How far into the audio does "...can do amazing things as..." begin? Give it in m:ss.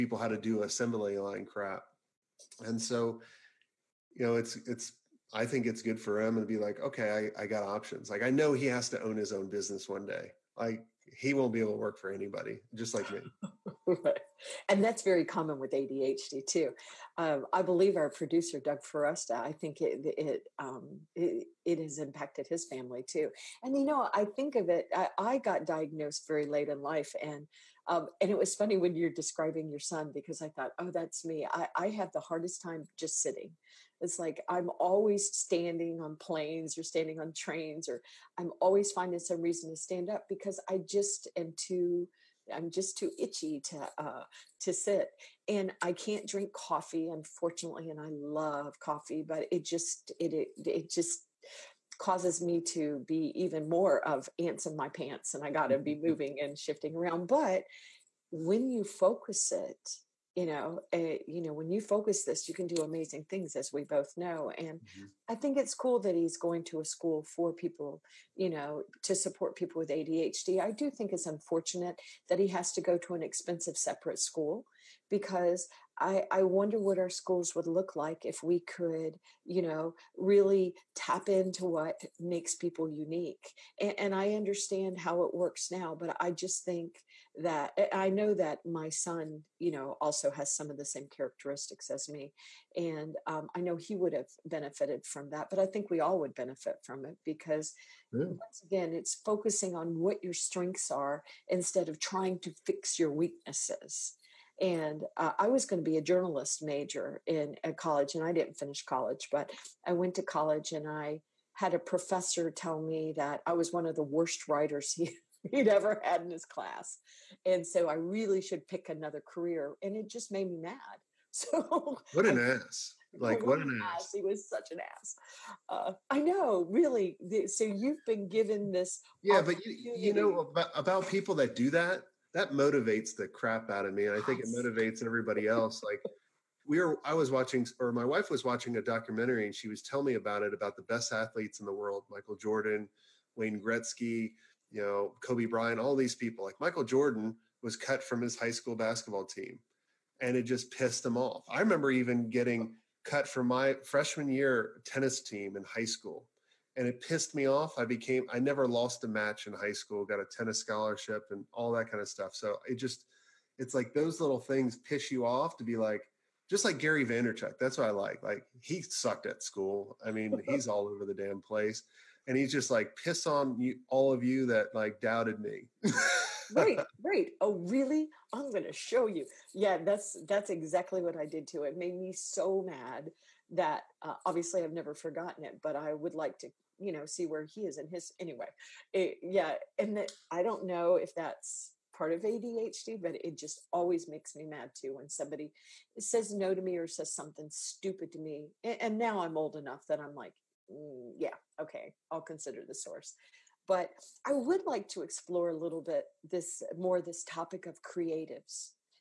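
1:02.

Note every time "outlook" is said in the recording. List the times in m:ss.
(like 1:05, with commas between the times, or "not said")
not said.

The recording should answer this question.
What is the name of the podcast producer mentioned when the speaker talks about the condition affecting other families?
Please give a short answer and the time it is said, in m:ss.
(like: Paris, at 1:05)
Doug Foresta, at 0:18.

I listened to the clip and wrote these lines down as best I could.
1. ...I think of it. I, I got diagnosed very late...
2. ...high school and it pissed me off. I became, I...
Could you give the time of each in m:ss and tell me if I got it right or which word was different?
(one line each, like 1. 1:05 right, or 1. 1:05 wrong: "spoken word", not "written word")
1. 0:24 right
2. 2:35 right.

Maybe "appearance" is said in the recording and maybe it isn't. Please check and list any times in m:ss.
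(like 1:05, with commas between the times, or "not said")
not said.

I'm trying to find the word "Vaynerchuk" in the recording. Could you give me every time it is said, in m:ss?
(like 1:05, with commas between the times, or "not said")
2:47.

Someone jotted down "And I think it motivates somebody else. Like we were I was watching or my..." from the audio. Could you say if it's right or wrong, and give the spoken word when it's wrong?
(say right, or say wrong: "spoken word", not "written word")
wrong: "everybody", not "somebody".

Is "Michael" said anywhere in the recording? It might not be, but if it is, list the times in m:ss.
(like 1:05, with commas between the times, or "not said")
2:22, 2:26.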